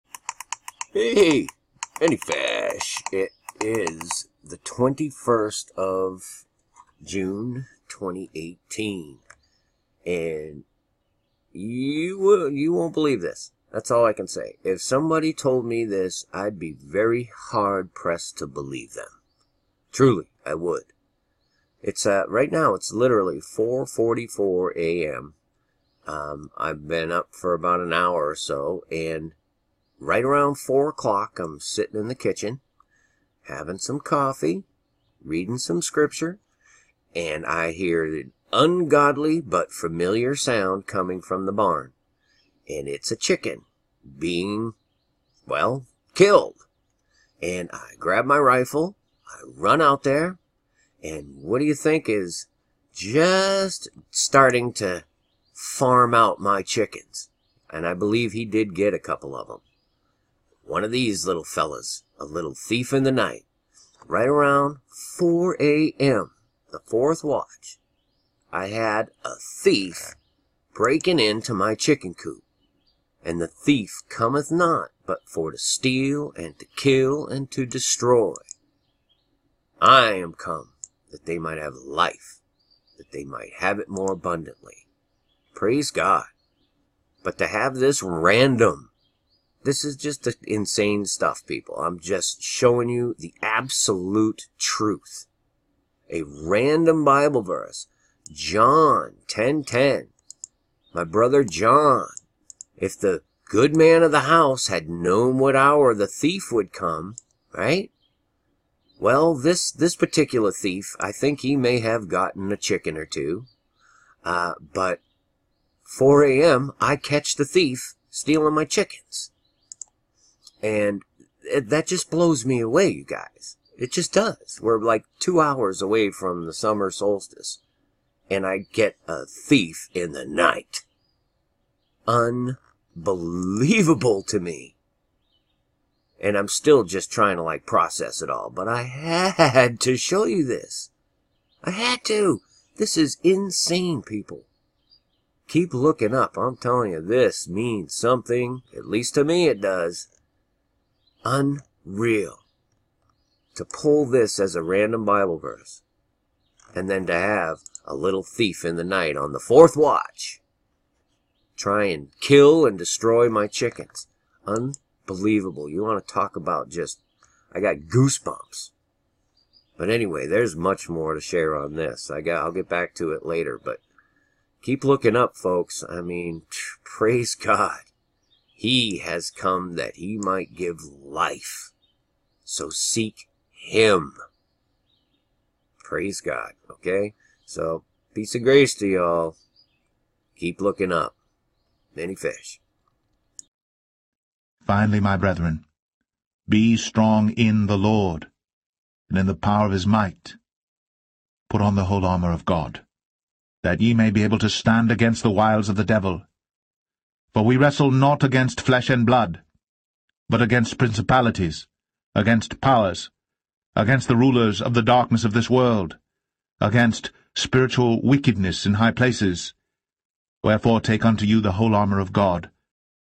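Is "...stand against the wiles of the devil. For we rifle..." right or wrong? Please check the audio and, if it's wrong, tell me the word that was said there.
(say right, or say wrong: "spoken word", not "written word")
wrong: "wrestle", not "rifle".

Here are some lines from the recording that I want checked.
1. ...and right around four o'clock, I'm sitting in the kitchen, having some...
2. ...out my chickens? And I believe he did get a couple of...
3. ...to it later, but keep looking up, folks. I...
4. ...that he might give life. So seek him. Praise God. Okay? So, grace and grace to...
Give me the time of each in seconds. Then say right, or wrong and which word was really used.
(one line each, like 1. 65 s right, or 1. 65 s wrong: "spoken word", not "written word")
1. 28 s right
2. 56 s right
3. 172 s right
4. 179 s wrong: "peace", not "grace".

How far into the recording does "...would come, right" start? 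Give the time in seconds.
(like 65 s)
106 s.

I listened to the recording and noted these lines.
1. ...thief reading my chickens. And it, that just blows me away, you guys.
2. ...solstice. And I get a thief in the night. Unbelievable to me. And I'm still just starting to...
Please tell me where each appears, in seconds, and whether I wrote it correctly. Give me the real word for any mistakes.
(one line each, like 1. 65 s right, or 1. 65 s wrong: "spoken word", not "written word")
1. 117 s wrong: "stealing", not "reading"
2. 126 s wrong: "trying", not "starting".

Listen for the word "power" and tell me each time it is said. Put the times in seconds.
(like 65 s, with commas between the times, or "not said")
199 s, 212 s.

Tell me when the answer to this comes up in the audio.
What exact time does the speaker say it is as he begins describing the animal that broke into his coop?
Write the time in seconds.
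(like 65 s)
23 s.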